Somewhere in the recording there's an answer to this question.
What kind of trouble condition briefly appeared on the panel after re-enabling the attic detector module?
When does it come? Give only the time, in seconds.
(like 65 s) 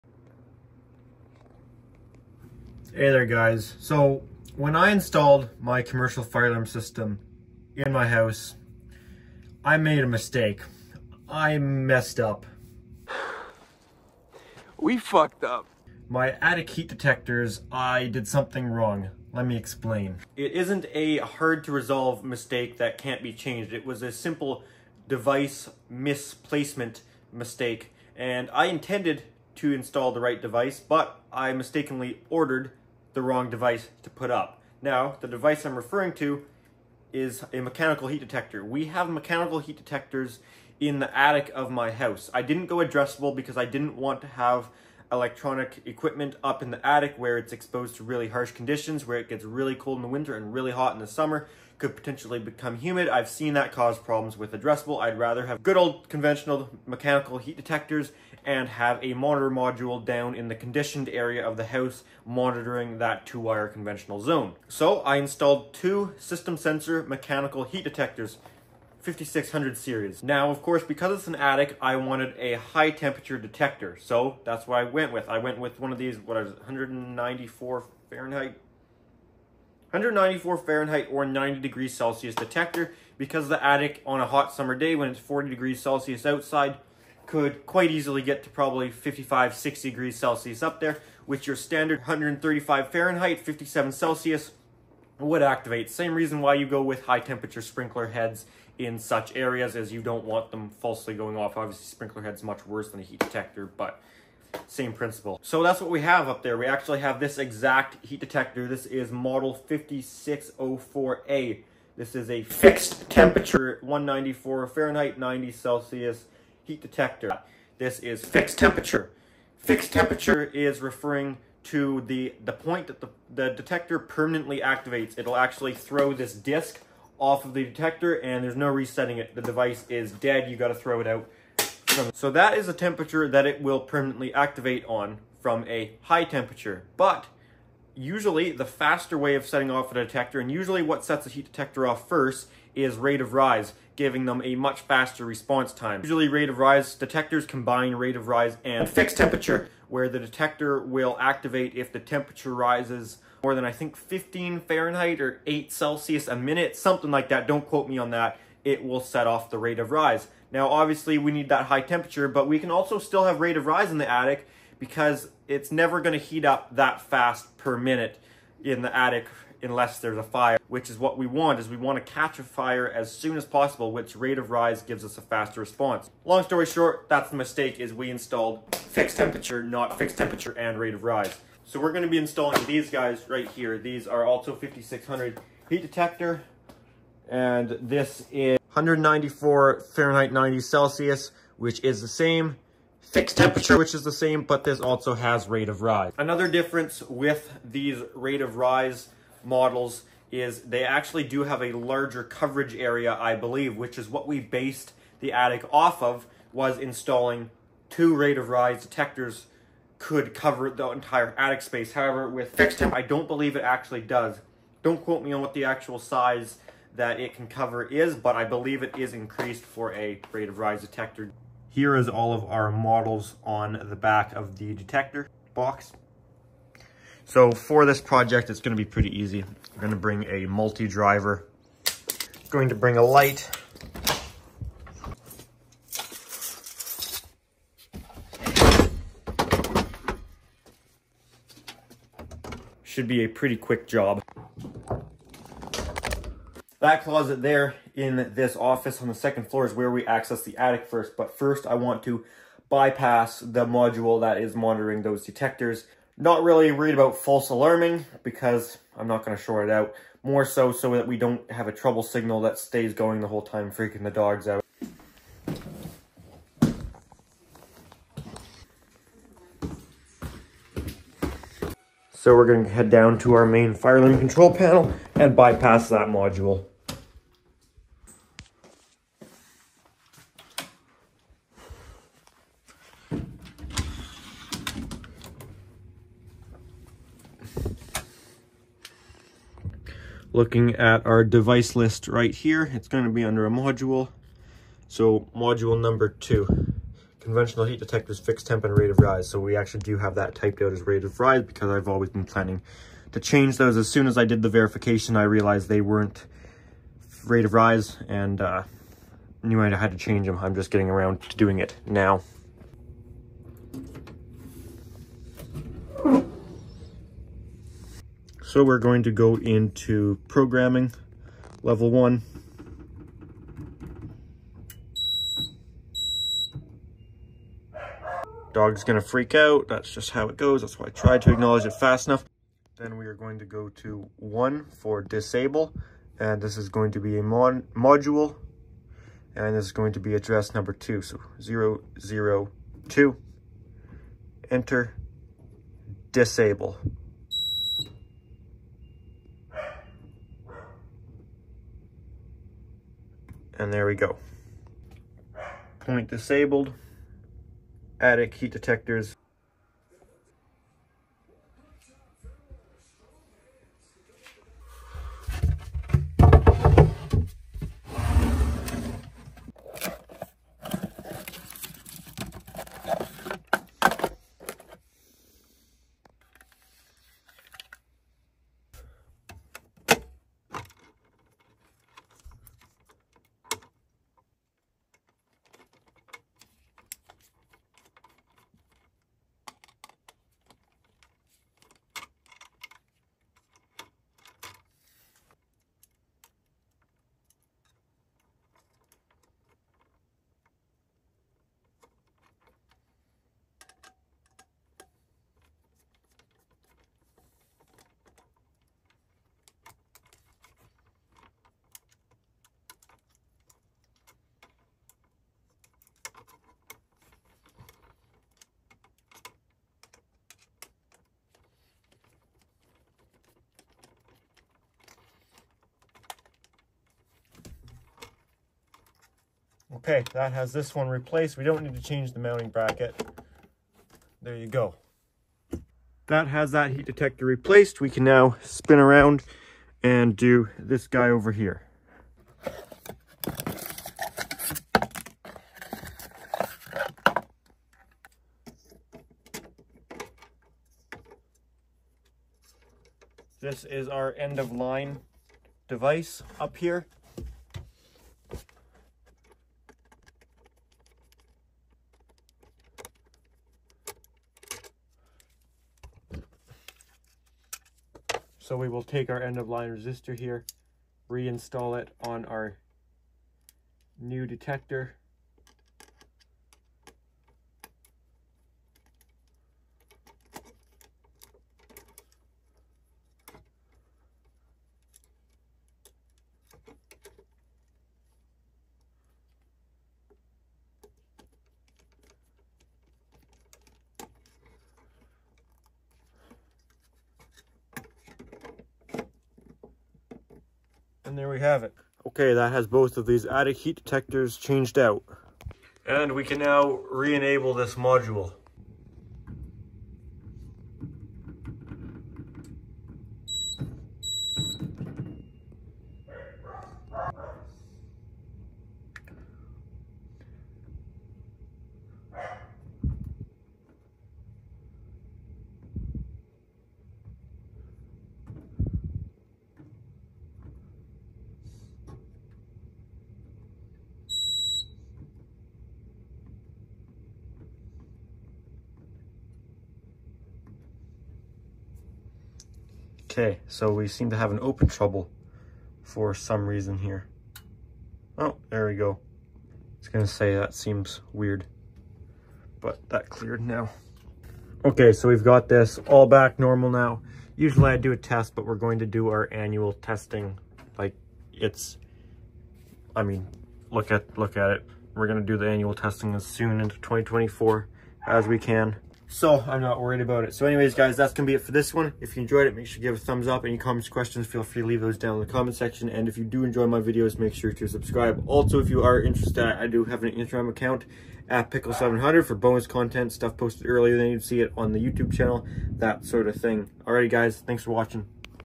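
544 s.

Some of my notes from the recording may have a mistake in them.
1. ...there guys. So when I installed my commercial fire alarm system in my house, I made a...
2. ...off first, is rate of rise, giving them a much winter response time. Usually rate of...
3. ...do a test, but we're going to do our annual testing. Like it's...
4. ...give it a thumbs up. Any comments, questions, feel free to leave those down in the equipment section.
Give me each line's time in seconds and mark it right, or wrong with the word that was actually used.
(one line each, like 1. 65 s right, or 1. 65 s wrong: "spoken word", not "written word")
1. 3 s right
2. 141 s wrong: "faster", not "winter"
3. 557 s right
4. 572 s wrong: "comment", not "equipment".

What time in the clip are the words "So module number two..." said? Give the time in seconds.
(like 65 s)
294 s.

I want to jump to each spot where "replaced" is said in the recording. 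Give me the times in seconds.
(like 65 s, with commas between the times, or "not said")
430 s, 437 s.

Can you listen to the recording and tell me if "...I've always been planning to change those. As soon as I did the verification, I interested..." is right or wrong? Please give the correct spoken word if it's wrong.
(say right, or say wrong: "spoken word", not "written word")
wrong: "realized", not "interested".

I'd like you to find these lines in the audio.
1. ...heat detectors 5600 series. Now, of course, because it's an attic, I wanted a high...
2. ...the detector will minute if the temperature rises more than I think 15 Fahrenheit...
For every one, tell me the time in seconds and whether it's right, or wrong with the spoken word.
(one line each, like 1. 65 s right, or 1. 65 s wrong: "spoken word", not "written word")
1. 67 s right
2. 150 s wrong: "activate", not "minute".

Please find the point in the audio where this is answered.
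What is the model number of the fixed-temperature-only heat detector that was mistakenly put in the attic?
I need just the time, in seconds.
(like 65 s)
109 s.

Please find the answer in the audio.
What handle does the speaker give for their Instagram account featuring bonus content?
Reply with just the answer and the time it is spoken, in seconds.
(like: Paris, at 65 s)
Pickle700, at 581 s.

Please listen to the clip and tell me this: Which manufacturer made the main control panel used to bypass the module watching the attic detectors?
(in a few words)
Fire-Lite.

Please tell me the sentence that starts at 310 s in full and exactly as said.
I'm just getting around to doing it now.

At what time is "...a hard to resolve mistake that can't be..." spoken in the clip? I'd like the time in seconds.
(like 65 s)
20 s.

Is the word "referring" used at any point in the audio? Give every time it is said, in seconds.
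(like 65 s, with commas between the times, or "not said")
35 s, 120 s.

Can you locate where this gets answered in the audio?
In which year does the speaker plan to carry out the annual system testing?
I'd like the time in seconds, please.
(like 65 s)
566 s.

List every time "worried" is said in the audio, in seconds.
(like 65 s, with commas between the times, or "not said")
256 s, 569 s.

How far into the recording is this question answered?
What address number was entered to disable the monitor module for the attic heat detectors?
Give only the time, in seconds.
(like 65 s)
341 s.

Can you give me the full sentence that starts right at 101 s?
Obviously sprinkler head's much worse than a heat detector, but same principle.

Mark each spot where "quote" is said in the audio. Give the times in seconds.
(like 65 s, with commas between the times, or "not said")
157 s, 215 s.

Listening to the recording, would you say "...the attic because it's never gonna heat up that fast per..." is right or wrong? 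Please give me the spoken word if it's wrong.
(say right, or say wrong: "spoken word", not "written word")
right.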